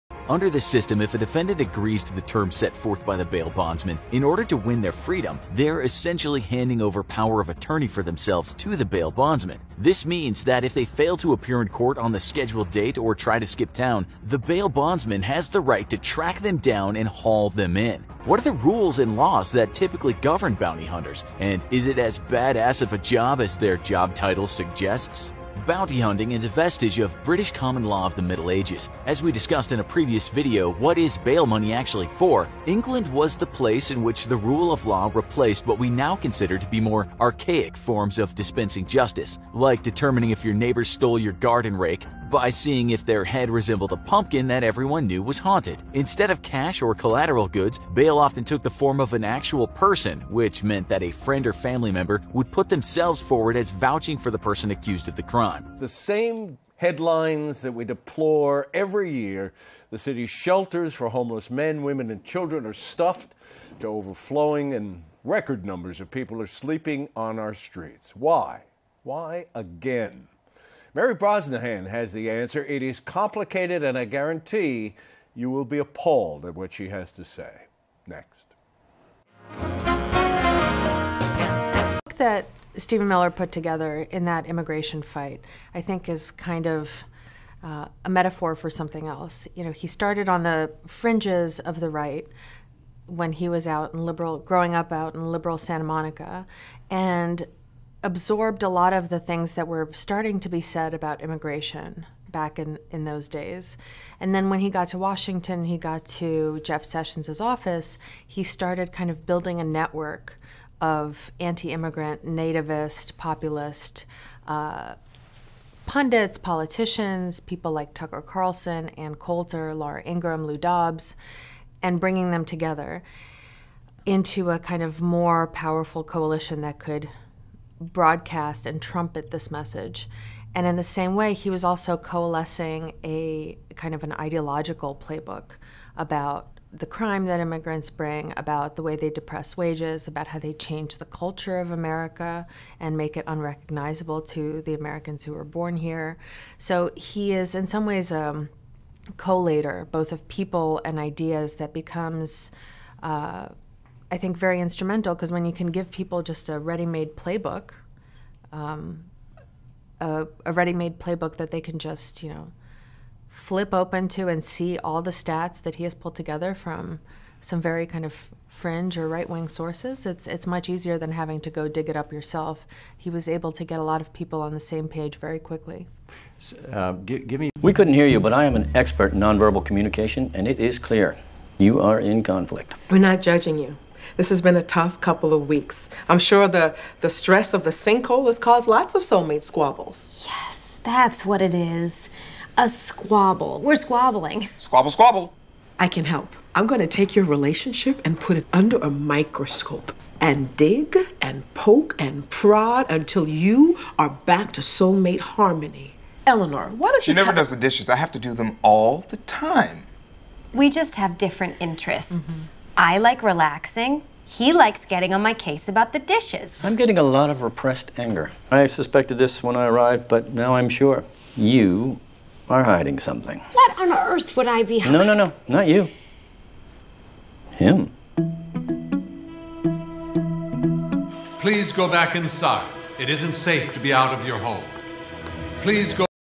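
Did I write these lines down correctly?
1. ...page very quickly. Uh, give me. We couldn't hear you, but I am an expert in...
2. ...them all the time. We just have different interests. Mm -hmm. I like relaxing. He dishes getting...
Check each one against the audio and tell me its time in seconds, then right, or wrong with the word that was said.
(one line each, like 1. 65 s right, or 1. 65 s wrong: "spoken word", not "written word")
1. 174 s right
2. 208 s wrong: "likes", not "dishes".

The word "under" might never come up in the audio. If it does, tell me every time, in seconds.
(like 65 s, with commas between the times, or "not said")
0 s, 198 s.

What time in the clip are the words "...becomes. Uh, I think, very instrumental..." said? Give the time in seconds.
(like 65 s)
151 s.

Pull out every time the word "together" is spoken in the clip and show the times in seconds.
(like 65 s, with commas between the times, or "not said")
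83 s, 122 s, 166 s.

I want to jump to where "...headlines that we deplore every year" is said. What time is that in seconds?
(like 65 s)
56 s.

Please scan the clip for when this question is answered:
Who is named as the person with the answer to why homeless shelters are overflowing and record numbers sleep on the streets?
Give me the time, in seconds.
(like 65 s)
70 s.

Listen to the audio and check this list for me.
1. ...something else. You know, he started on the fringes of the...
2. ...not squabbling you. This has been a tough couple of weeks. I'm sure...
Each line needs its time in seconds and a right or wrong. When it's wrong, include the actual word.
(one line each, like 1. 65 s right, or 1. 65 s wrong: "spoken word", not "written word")
1. 88 s right
2. 182 s wrong: "judging", not "squabbling".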